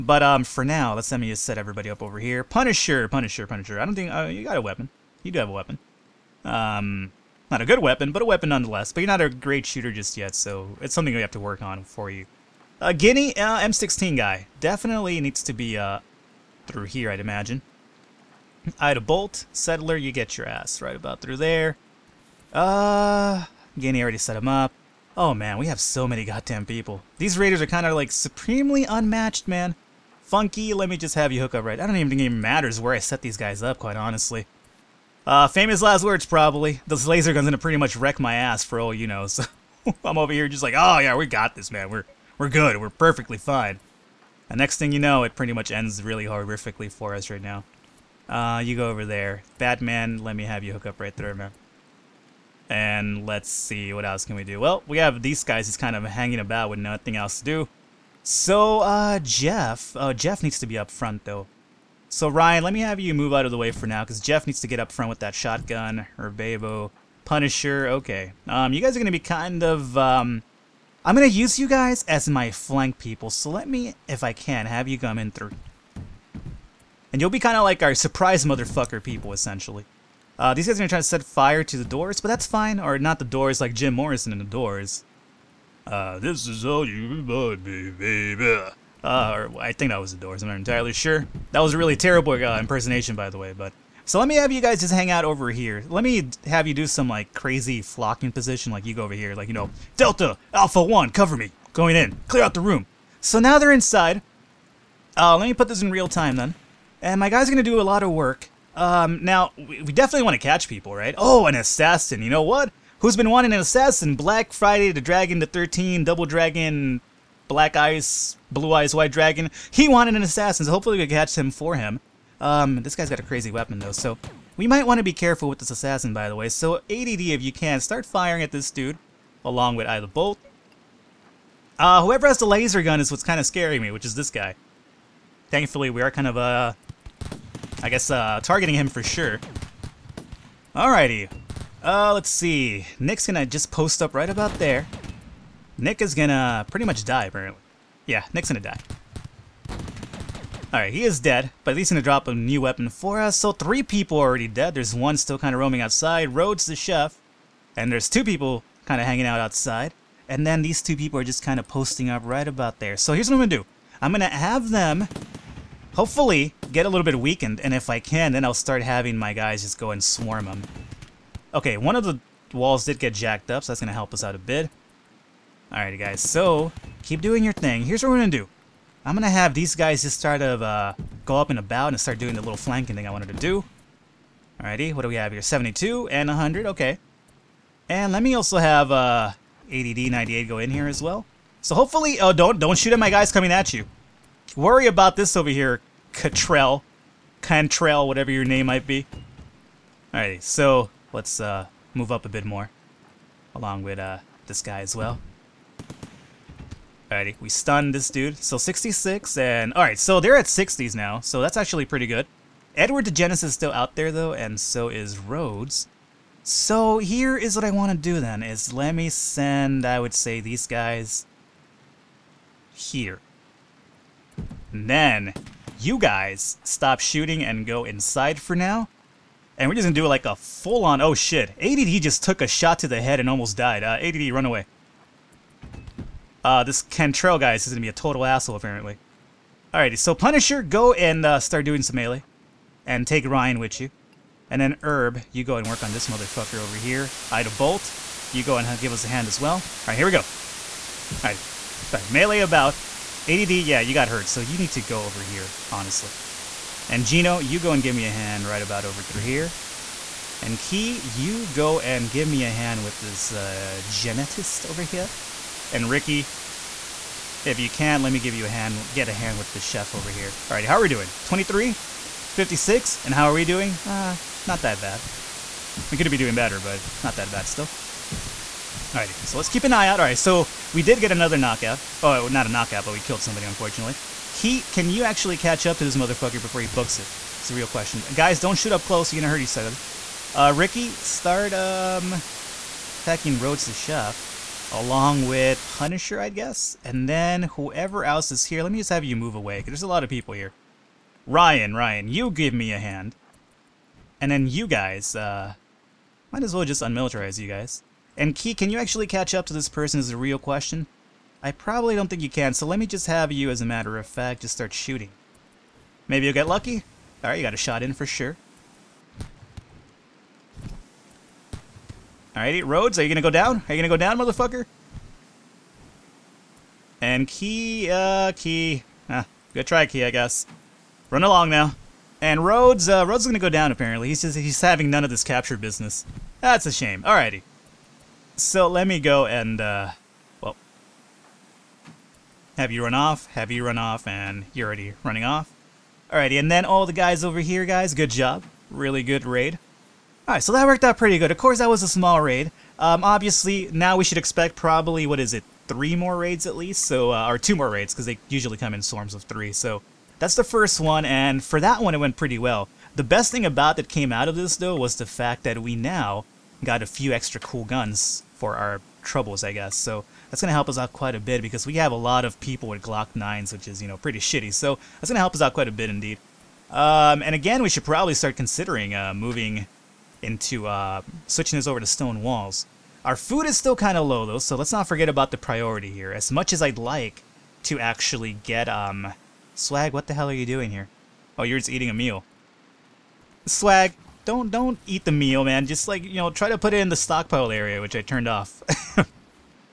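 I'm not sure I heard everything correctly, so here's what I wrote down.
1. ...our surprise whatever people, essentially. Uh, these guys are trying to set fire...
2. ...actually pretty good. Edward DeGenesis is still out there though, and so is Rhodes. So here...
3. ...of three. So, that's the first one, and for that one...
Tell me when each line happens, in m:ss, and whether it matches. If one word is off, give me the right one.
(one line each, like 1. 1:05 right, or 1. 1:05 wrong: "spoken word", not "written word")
1. 1:17 wrong: "motherfucker", not "whatever"
2. 3:31 right
3. 5:59 right.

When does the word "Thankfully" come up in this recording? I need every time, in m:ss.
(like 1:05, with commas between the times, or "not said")
2:15.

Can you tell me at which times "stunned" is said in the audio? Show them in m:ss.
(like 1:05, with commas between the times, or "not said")
3:27.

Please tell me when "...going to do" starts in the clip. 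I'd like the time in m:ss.
2:58.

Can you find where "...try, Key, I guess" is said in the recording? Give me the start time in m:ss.
5:29.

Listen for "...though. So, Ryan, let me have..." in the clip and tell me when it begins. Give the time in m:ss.
1:01.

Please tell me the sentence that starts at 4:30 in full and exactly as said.
All right, how are we doing?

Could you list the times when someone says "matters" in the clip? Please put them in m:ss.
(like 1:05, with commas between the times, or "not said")
0:32, 5:13.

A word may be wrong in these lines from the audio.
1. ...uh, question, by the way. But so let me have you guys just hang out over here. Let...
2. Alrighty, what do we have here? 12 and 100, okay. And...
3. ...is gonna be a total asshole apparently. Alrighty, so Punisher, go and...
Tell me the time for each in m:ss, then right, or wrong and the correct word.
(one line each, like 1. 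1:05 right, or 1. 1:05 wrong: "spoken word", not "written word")
1. 1:32 wrong: "impersonation", not "question"
2. 3:04 wrong: "72", not "12"
3. 3:57 right.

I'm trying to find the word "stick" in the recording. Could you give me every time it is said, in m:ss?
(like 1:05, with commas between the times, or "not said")
not said.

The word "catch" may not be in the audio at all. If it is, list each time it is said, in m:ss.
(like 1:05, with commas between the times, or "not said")
1:50, 2:01, 4:45, 5:09.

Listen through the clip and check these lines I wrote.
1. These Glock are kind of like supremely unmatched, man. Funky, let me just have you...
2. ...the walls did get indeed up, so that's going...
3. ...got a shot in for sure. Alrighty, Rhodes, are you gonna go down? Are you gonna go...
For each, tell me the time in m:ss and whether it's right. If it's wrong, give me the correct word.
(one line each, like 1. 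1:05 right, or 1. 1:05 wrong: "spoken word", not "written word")
1. 0:27 wrong: "Raiders", not "Glock"
2. 2:52 wrong: "jacked", not "indeed"
3. 5:17 right.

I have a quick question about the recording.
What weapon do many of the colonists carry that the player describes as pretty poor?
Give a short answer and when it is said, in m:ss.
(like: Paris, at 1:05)
Glock 9, at 6:12.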